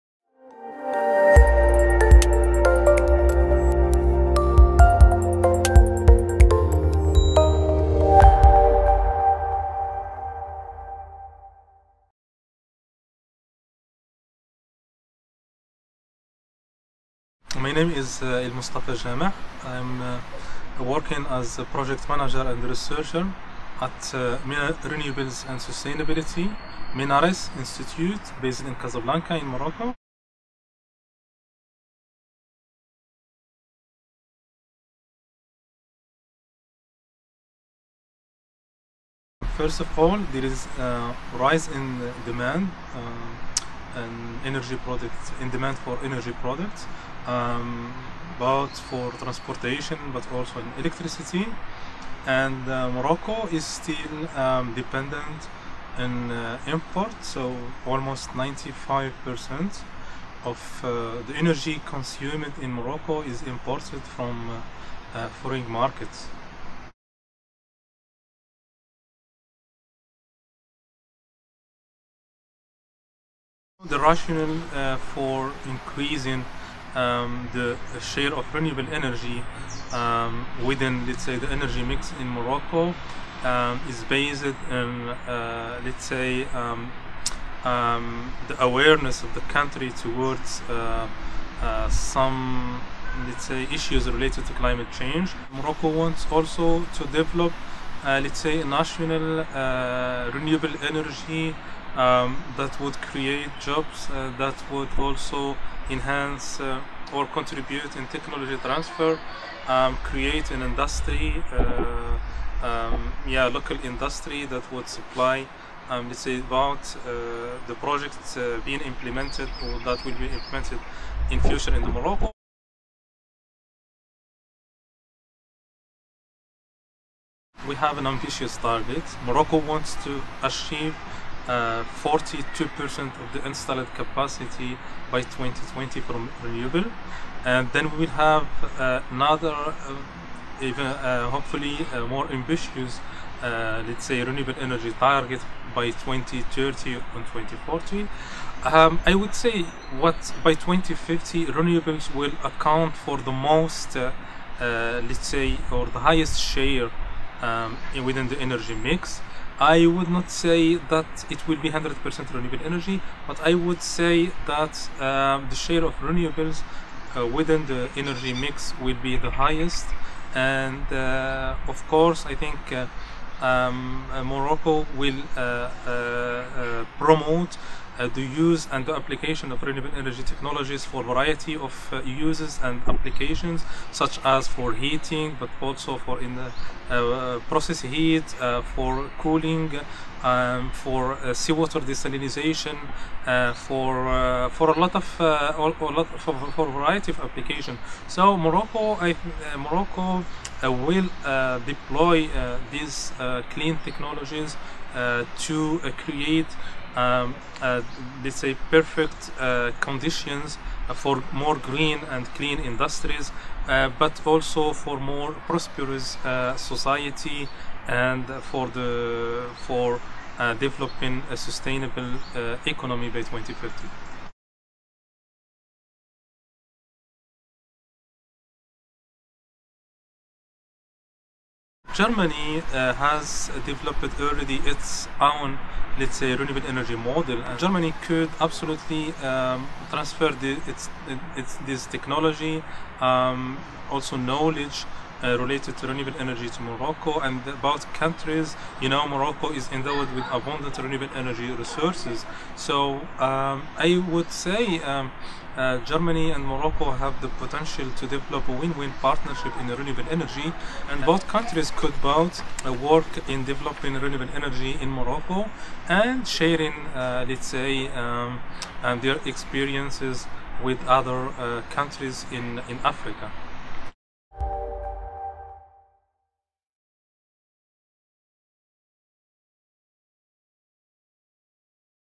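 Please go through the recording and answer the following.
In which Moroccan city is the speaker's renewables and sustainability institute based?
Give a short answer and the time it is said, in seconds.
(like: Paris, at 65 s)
Casablanca, at 28 s.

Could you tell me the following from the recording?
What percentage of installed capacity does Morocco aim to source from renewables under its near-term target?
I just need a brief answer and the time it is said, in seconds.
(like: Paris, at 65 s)
42%, at 131 s.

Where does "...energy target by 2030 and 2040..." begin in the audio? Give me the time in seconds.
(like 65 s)
144 s.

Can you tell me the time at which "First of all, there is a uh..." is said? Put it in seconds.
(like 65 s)
39 s.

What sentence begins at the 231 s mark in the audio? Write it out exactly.
Germany uh, has developed already its own, let's say, renewable energy model.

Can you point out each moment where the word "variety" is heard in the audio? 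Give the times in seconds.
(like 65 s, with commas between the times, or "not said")
181 s, 196 s.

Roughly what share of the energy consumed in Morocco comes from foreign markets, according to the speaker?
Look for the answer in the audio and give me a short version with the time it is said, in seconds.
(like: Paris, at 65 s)
95%, at 58 s.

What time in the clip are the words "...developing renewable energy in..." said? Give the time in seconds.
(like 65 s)
263 s.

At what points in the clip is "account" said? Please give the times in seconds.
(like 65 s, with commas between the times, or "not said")
152 s.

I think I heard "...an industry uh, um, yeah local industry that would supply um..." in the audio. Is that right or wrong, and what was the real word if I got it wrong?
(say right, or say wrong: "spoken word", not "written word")
right.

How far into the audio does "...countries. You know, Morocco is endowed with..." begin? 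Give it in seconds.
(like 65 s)
247 s.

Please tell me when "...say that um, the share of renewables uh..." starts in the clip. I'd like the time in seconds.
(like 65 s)
163 s.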